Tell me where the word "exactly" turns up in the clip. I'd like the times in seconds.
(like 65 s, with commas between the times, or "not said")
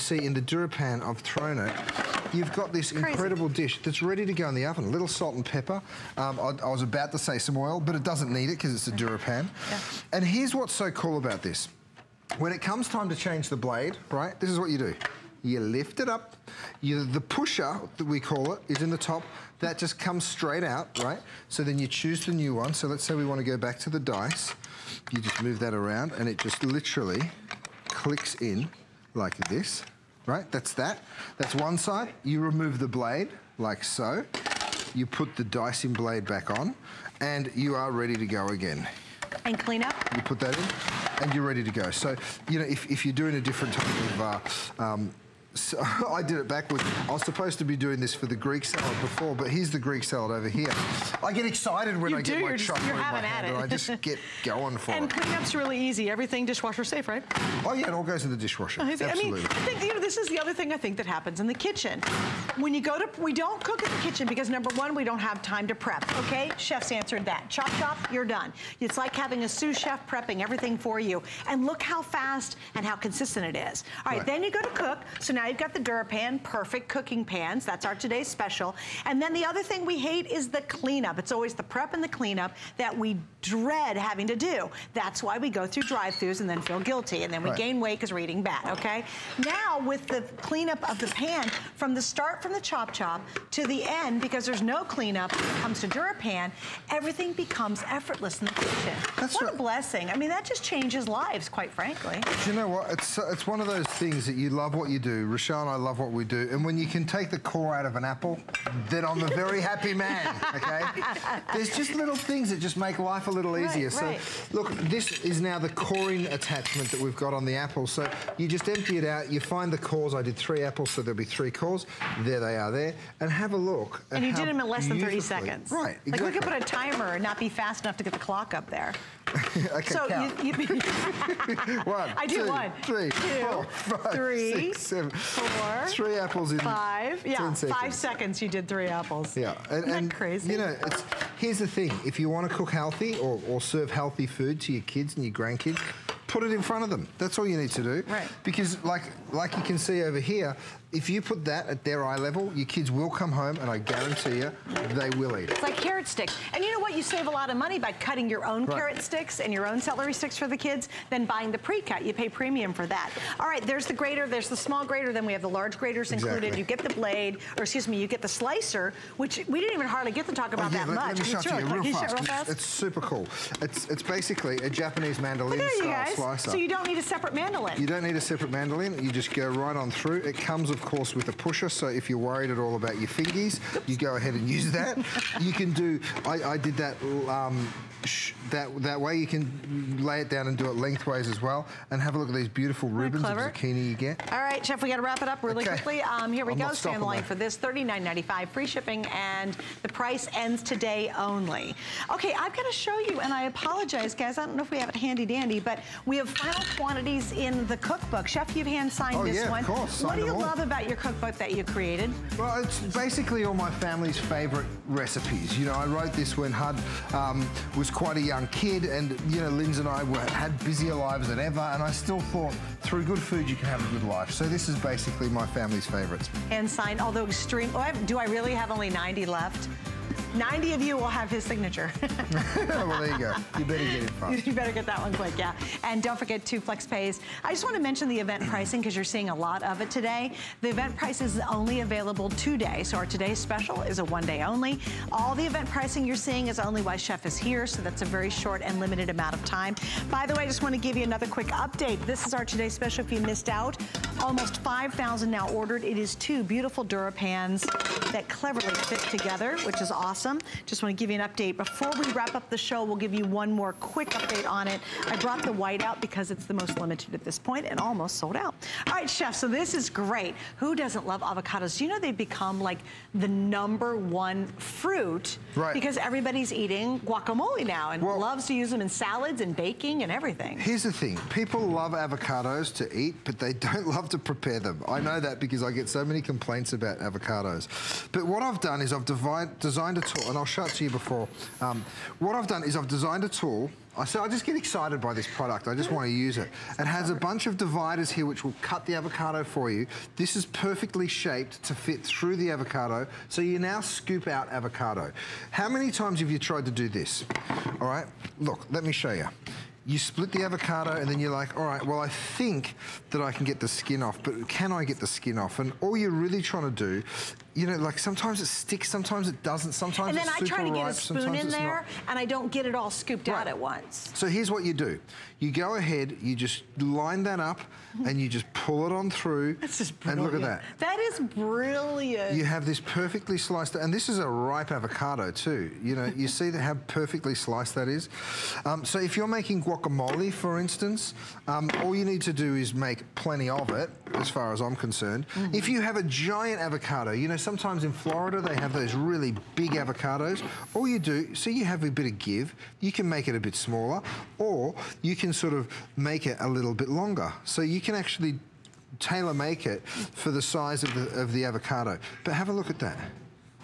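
126 s, 166 s.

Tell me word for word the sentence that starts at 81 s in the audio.
It's always the prep and the cleanup that we dread having to do.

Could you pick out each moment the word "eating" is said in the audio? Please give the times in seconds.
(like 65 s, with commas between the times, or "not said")
88 s, 276 s.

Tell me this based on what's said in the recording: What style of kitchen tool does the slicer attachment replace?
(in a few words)
Japanese mandolin.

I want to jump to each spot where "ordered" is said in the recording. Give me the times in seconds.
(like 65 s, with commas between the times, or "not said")
255 s.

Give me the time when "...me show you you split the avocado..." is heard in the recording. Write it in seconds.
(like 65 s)
308 s.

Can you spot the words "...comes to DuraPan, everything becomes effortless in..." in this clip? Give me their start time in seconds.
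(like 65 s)
95 s.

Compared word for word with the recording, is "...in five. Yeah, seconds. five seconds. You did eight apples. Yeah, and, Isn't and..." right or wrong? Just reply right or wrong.
wrong.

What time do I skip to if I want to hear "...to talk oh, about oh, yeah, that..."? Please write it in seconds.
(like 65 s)
170 s.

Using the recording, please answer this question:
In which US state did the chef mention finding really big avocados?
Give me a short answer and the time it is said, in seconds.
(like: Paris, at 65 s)
Florida, at 347 s.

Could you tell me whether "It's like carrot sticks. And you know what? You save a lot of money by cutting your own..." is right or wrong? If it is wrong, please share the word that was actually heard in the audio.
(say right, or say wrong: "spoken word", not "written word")
right.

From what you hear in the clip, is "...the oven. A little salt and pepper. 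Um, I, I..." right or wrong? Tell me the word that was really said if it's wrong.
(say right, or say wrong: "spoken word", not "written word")
right.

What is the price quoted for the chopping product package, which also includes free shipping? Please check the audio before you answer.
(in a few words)
$39.95.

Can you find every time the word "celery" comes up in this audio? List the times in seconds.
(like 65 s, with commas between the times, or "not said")
159 s.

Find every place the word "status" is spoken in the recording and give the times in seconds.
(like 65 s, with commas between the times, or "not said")
not said.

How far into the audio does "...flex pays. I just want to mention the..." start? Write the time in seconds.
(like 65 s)
236 s.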